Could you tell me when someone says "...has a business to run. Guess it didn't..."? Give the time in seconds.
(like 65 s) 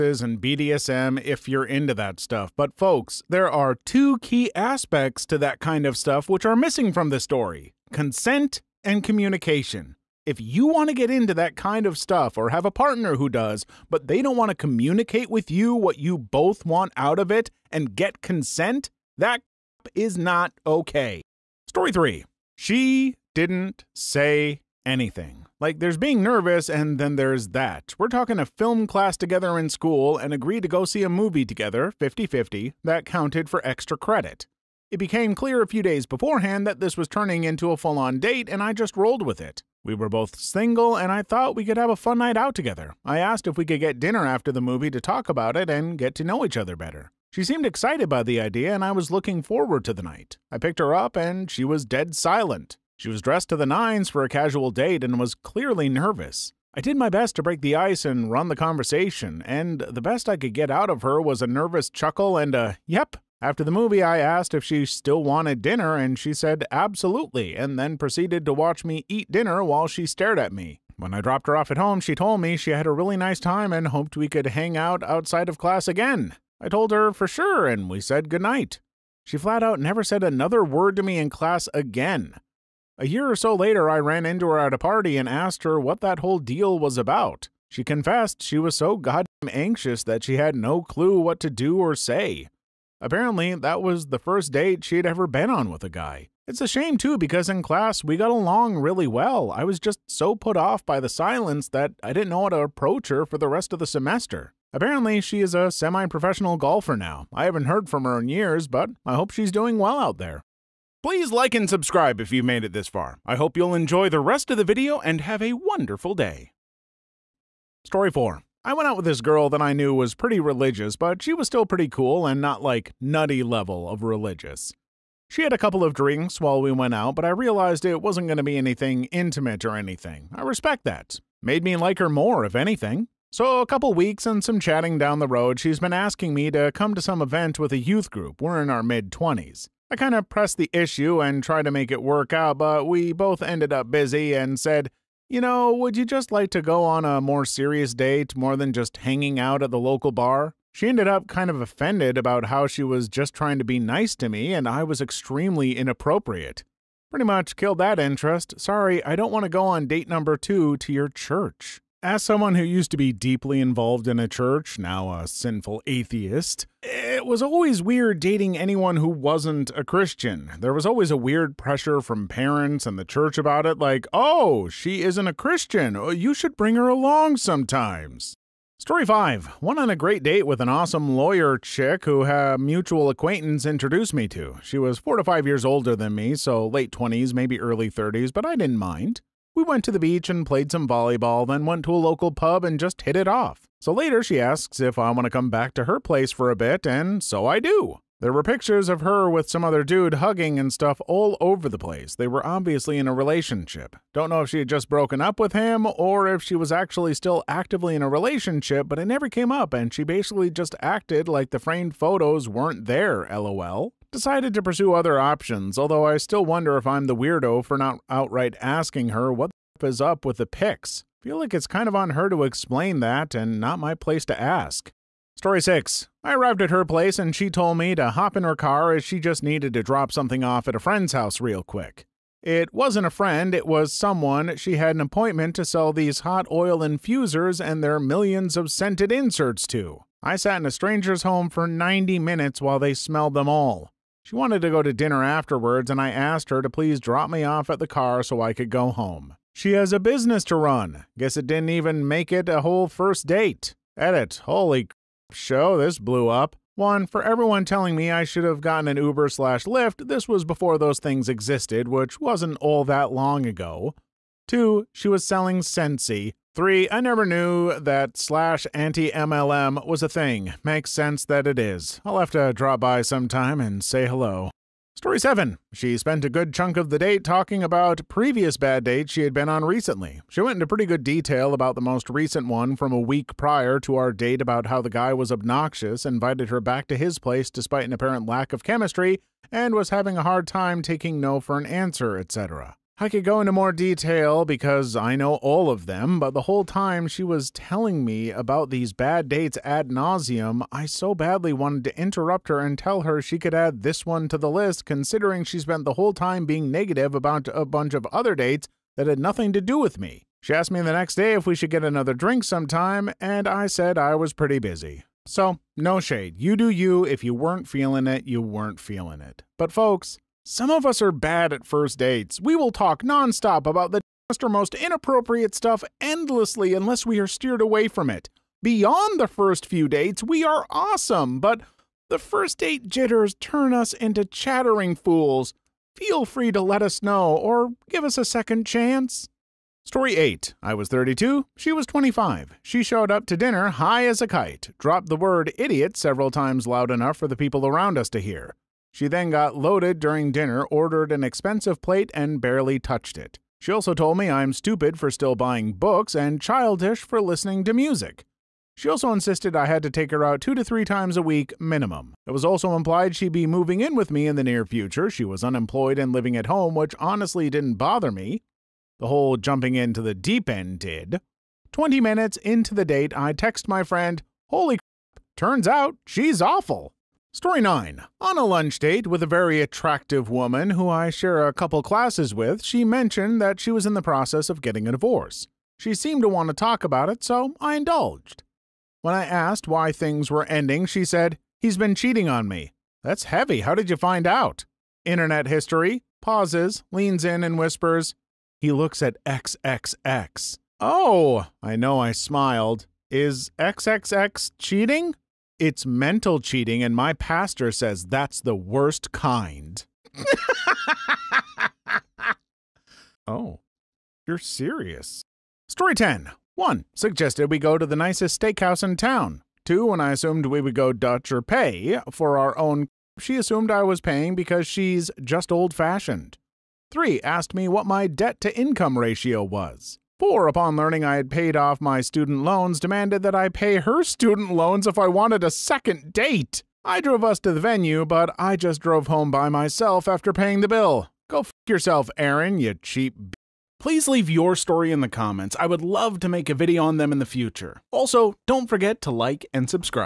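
249 s.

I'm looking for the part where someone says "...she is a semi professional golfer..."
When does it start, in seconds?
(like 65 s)
105 s.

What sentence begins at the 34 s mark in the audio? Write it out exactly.
It became clear a few days beforehand that this was turning into a full on date, and I just rolled with it.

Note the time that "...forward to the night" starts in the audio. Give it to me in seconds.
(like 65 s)
49 s.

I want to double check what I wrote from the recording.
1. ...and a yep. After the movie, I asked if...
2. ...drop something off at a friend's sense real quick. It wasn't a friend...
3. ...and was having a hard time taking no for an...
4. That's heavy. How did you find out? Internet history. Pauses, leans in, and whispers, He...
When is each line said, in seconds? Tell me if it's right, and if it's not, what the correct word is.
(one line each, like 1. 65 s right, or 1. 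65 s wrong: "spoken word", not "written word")
1. 62 s right
2. 229 s wrong: "house", not "sense"
3. 289 s right
4. 393 s right.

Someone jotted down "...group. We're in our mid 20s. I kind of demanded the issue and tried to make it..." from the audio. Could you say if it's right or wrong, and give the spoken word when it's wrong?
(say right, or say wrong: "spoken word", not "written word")
wrong: "pressed", not "demanded".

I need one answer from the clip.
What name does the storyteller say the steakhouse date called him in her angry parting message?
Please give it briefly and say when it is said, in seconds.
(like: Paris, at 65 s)
Aaron, at 442 s.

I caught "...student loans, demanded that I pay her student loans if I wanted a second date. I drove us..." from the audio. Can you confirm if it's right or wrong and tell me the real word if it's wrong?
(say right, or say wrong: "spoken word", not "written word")
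right.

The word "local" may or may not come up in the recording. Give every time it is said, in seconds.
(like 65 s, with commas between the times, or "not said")
149 s, 192 s.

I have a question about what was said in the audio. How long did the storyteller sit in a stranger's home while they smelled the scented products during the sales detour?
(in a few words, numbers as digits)
90 minutes.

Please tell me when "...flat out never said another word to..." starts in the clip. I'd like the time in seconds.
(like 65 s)
79 s.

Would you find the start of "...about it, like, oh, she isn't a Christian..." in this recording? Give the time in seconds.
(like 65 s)
173 s.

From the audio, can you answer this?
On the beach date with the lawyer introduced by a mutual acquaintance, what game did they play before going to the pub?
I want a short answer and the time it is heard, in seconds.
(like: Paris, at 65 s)
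volleyball, at 190 s.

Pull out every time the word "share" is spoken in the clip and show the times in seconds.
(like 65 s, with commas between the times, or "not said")
381 s.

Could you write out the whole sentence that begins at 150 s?
She ended up kind of offended about how she was just trying to be nice to me and I was extremely inappropriate.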